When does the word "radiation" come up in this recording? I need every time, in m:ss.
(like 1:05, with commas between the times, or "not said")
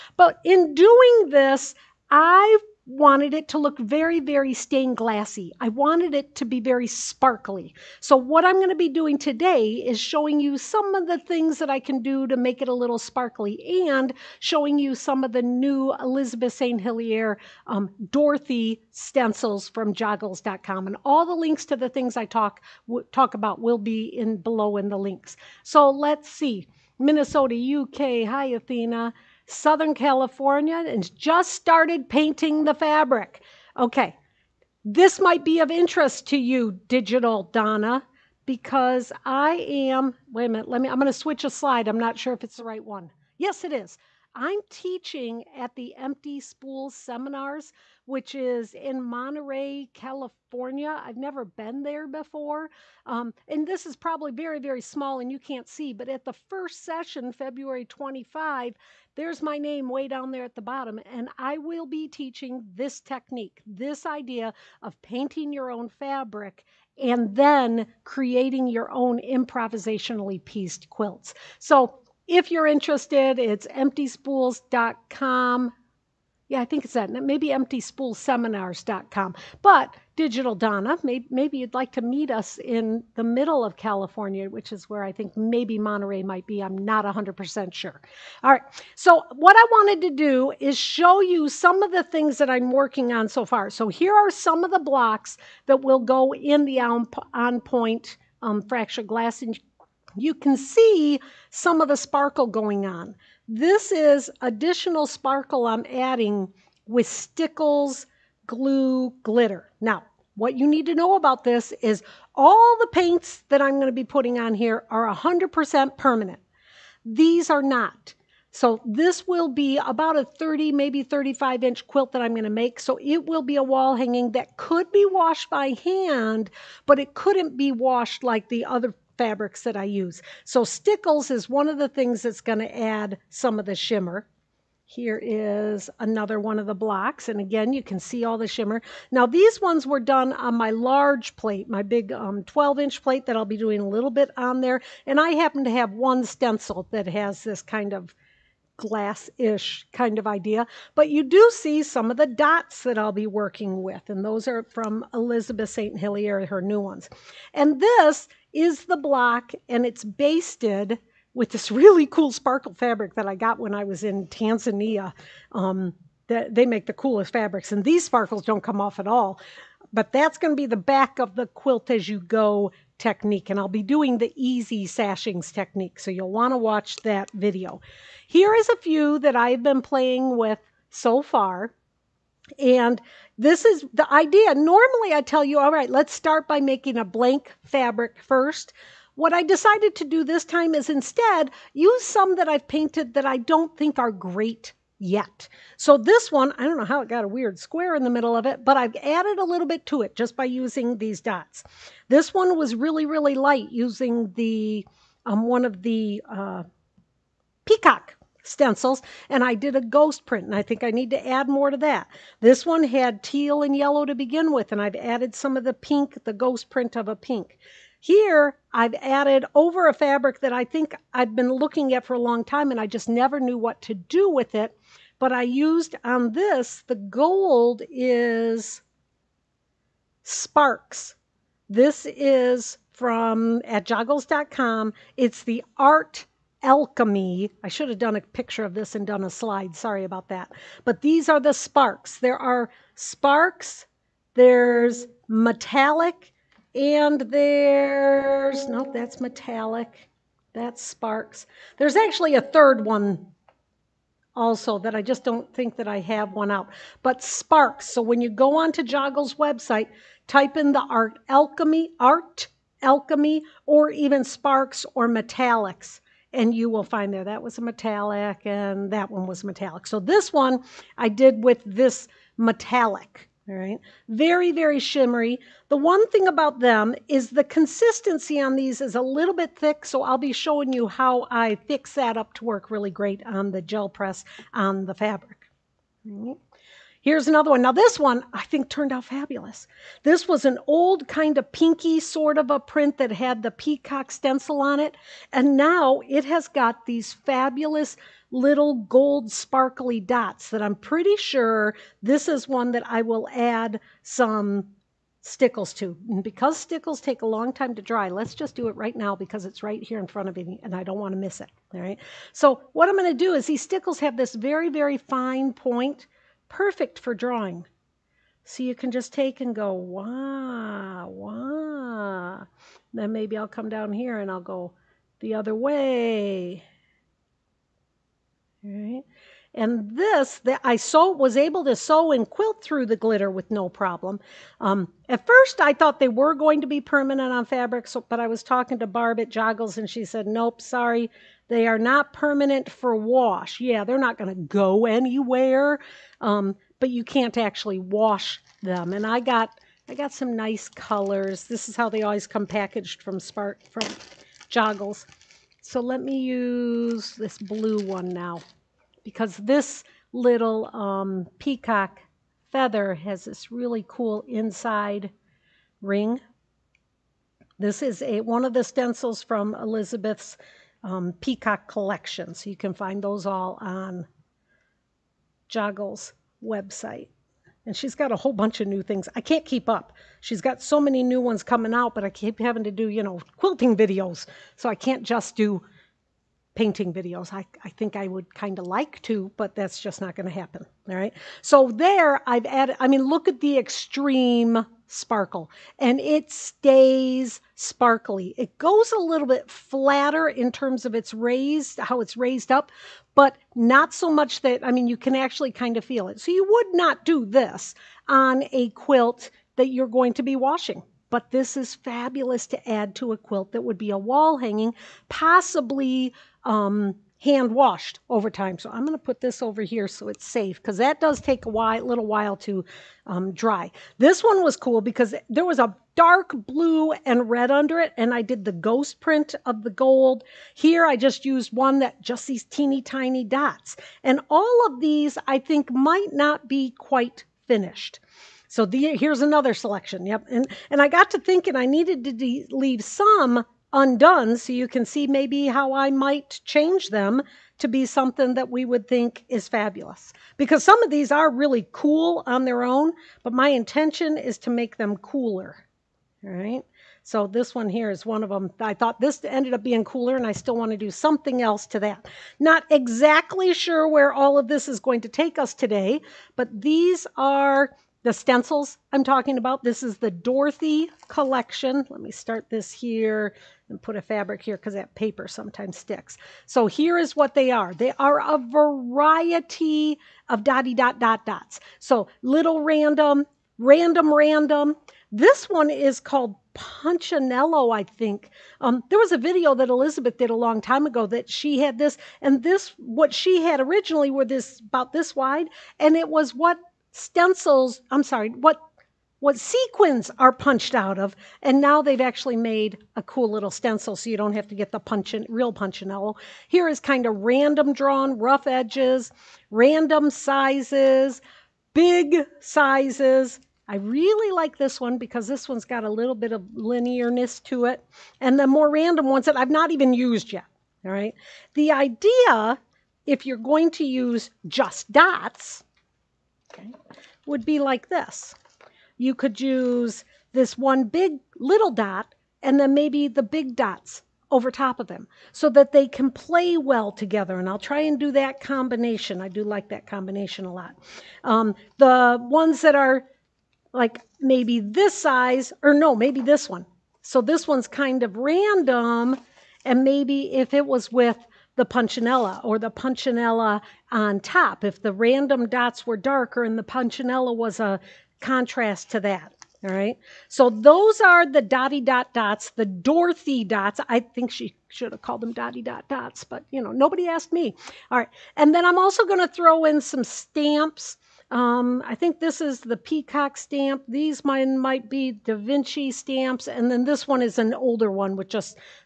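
not said.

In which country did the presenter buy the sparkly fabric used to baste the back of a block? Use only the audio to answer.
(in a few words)
Tanzania.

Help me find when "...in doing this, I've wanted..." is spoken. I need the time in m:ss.
0:00.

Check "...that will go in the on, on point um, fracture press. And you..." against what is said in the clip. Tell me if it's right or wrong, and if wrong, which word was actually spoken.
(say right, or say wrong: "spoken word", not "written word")
wrong: "glass", not "press".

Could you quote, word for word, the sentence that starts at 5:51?
This is how they always come packaged from Spark from Joggles.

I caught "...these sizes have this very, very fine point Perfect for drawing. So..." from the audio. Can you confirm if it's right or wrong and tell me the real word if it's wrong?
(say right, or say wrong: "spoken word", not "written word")
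wrong: "stickles", not "sizes".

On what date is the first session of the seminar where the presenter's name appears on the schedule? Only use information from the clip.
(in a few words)
February 25.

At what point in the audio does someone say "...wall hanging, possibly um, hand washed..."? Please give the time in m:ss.
6:53.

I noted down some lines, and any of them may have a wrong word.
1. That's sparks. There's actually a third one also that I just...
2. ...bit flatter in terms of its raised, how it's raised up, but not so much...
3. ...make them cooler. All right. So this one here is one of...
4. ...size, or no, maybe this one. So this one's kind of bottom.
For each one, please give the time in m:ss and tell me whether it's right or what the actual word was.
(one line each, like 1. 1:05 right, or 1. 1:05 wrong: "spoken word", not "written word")
1. 4:10 right
2. 6:39 right
3. 7:34 right
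4. 9:04 wrong: "random", not "bottom".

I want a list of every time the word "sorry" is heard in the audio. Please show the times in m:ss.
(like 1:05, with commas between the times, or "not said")
3:59, 5:40, 8:18.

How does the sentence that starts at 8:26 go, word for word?
Here is kind of random drawn, rough edges, random sizes, big sizes.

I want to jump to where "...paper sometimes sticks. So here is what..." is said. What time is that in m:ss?
7:54.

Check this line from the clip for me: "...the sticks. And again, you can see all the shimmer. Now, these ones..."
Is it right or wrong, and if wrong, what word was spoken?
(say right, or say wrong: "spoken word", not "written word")
wrong: "blocks", not "sticks".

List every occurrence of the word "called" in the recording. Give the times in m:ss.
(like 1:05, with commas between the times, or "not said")
8:05, 9:25.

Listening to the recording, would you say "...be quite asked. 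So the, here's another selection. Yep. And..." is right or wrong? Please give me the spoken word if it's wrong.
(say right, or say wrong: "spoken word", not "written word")
wrong: "finished", not "asked".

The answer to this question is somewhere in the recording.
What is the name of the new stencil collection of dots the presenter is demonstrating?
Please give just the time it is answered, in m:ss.
7:50.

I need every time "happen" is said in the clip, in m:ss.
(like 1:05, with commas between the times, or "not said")
2:25, 6:30.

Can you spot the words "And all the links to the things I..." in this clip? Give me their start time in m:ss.
0:20.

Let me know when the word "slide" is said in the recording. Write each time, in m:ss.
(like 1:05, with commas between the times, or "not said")
0:41, 3:59.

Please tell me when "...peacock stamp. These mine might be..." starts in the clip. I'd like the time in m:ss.
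9:32.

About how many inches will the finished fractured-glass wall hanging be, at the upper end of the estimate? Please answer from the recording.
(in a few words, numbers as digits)
35 inches.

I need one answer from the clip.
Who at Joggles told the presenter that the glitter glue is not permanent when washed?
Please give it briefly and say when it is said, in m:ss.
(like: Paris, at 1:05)
Barb, at 5:38.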